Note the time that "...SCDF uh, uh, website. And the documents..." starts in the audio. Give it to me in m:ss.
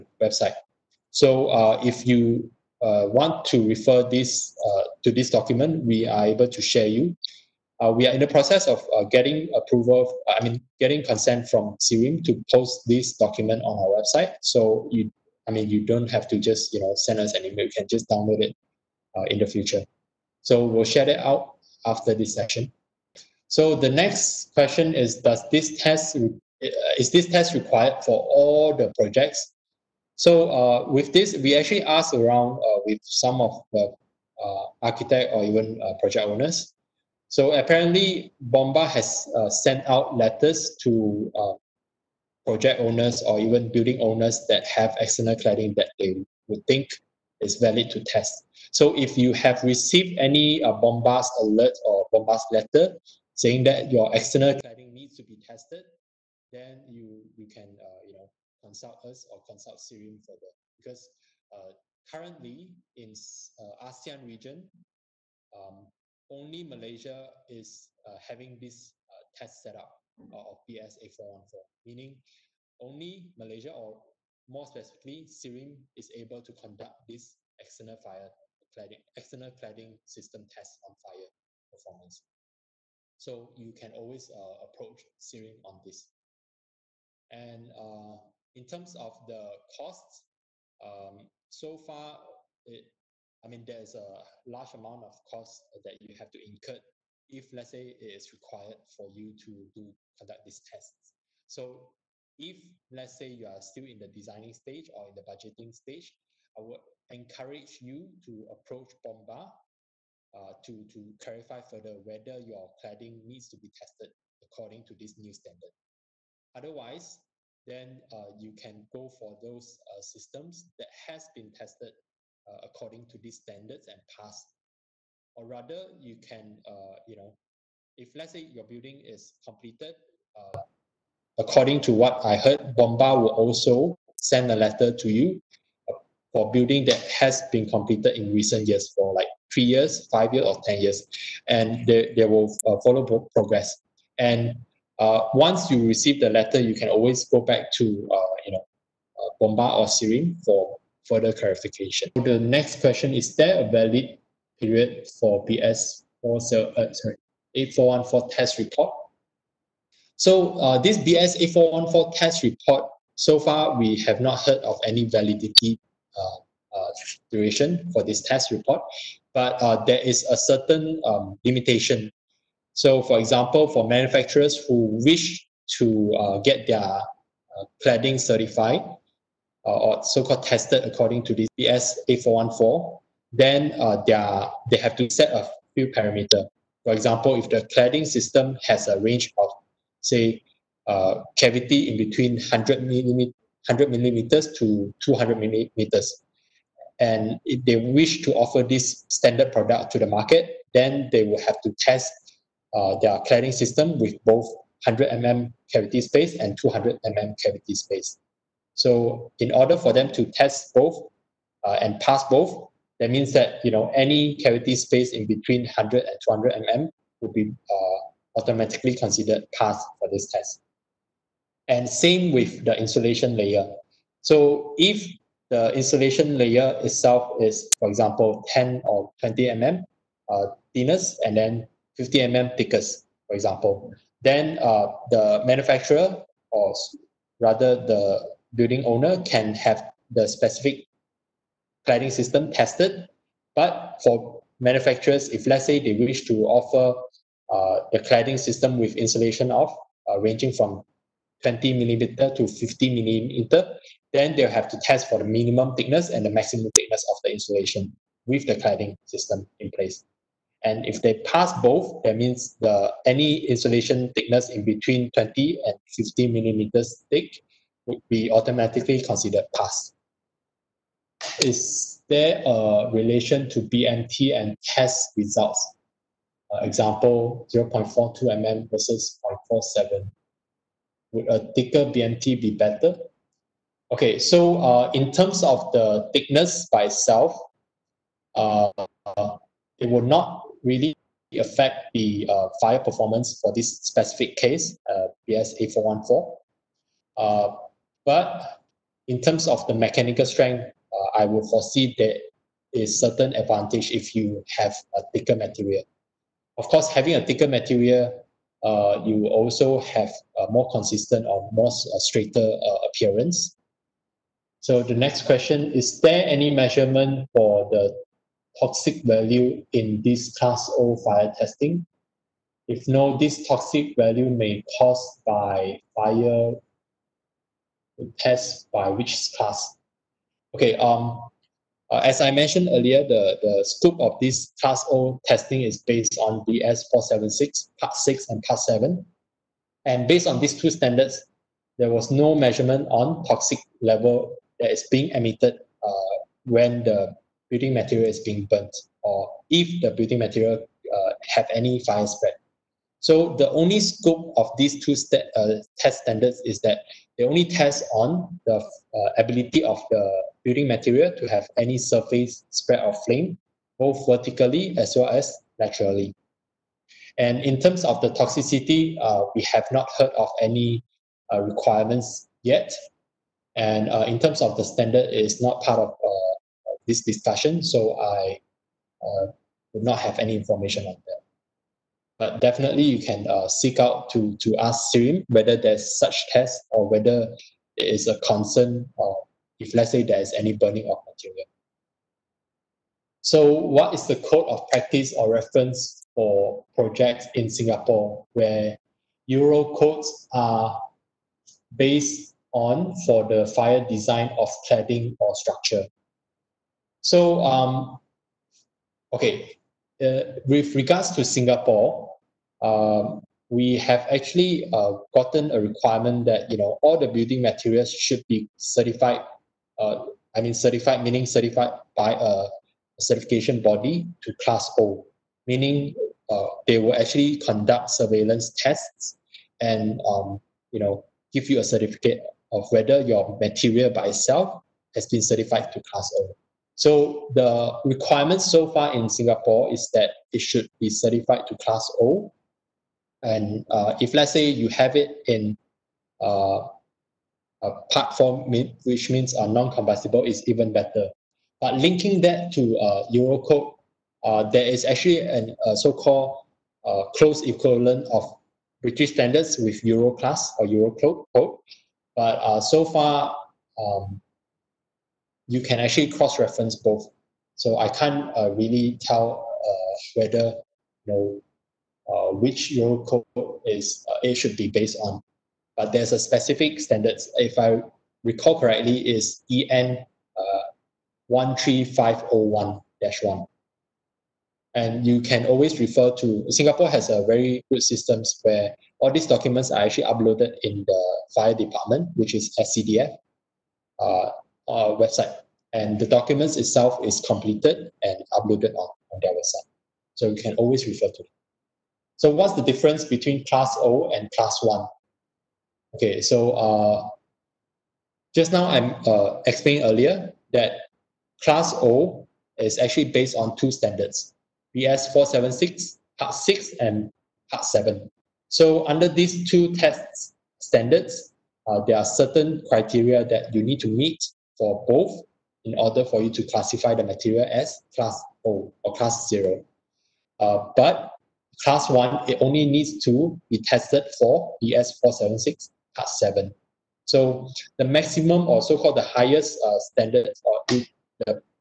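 8:12.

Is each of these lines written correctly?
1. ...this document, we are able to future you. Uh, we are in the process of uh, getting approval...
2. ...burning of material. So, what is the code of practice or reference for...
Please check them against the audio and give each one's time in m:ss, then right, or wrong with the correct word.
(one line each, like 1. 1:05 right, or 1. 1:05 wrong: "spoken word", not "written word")
1. 0:05 wrong: "share", not "future"
2. 6:30 right.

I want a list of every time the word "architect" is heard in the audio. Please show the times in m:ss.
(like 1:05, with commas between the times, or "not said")
0:34.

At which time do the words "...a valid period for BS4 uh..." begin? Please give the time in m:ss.
2:33.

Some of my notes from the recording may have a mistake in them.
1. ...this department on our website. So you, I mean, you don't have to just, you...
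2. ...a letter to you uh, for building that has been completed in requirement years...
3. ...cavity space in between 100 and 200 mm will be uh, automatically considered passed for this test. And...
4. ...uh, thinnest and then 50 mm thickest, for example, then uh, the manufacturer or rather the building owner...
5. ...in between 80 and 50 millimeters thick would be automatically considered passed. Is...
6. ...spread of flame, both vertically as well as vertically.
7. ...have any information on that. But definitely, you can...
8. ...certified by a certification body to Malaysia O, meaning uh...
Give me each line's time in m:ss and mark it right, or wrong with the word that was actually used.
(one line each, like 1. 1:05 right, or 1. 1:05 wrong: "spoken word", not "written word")
1. 0:12 wrong: "document", not "department"
2. 2:14 wrong: "recent", not "requirement"
3. 3:34 right
4. 3:50 right
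5. 4:24 wrong: "20", not "80"
6. 6:02 wrong: "laterally", not "vertically"
7. 6:19 right
8. 7:01 wrong: "Class", not "Malaysia".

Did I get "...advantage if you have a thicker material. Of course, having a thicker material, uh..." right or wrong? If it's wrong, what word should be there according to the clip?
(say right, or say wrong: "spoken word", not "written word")
right.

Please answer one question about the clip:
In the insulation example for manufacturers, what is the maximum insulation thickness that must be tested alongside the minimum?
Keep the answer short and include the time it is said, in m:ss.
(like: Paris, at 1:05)
50 mm, at 4:12.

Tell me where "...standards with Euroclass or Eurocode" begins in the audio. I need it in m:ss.
7:39.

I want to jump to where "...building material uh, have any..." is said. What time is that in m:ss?
5:49.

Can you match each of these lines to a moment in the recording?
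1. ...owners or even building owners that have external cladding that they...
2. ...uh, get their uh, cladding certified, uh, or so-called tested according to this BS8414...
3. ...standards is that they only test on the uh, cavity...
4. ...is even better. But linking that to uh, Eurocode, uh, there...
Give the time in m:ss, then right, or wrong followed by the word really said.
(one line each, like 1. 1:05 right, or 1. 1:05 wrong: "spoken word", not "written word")
1. 0:42 right
2. 2:56 right
3. 5:56 wrong: "ability", not "cavity"
4. 7:30 right.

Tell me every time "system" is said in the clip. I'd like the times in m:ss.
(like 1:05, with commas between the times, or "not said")
1:20, 2:00, 3:08, 3:23, 4:02, 4:08, 4:19, 8:07.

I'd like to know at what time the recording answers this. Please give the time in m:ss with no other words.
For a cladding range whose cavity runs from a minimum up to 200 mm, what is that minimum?
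3:13.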